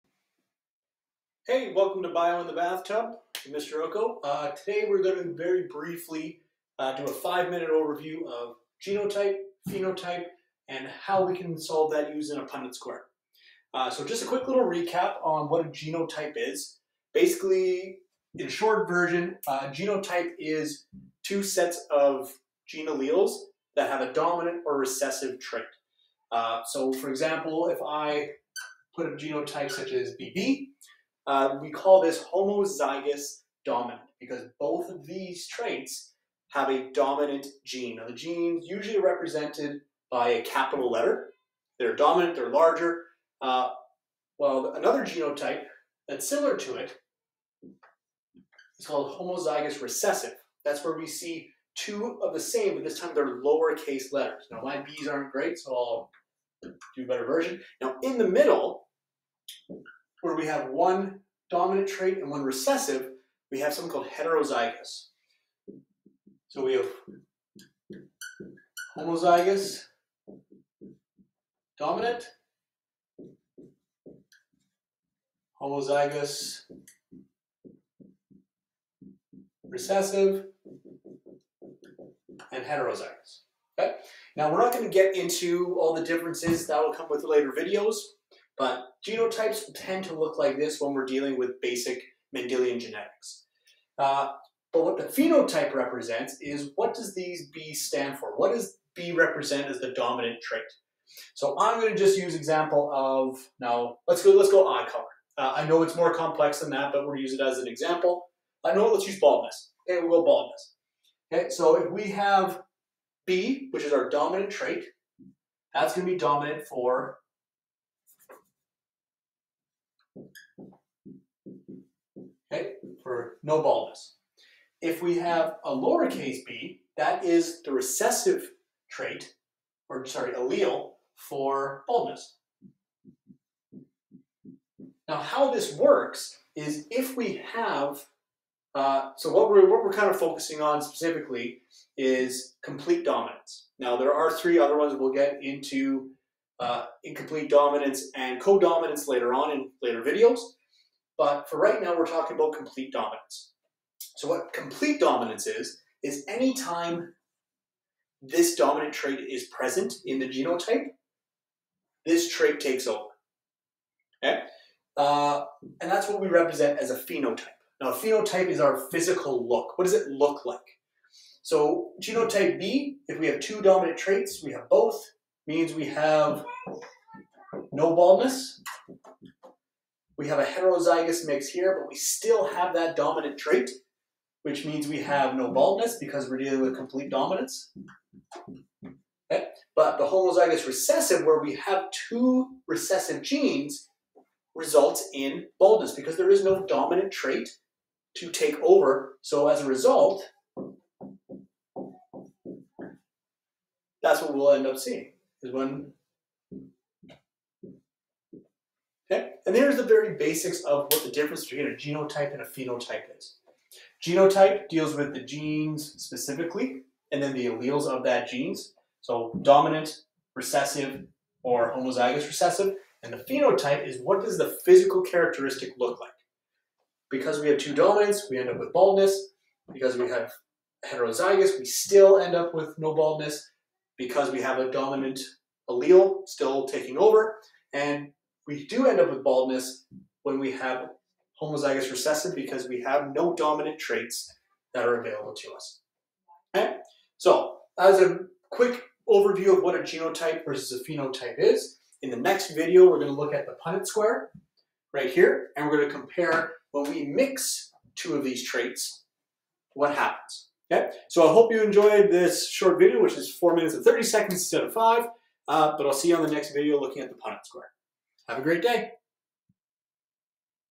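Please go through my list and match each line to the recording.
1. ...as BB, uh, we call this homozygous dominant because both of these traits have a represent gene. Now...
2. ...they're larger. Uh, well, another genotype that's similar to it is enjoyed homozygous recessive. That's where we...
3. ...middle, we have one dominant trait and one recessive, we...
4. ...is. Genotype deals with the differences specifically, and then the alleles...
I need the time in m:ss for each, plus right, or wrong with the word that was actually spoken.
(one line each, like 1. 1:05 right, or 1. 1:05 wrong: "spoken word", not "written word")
1. 0:29 wrong: "dominant", not "represent"
2. 0:42 wrong: "called", not "enjoyed"
3. 0:58 right
4. 3:33 wrong: "genes", not "differences".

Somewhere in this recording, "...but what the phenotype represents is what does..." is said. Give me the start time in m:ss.
1:34.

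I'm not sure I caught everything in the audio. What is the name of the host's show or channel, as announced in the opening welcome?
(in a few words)
Bio in the Bathtub.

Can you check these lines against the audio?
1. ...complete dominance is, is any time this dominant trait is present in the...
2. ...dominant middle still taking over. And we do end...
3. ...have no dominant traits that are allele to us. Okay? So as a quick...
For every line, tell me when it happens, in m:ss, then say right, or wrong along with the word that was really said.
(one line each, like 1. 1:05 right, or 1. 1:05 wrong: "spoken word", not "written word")
1. 2:34 right
2. 3:54 wrong: "allele", not "middle"
3. 4:02 wrong: "available", not "allele".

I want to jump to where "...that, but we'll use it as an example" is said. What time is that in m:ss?
1:46.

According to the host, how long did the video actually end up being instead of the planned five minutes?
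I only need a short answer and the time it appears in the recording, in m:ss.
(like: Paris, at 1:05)
4 minutes and 30 seconds, at 4:23.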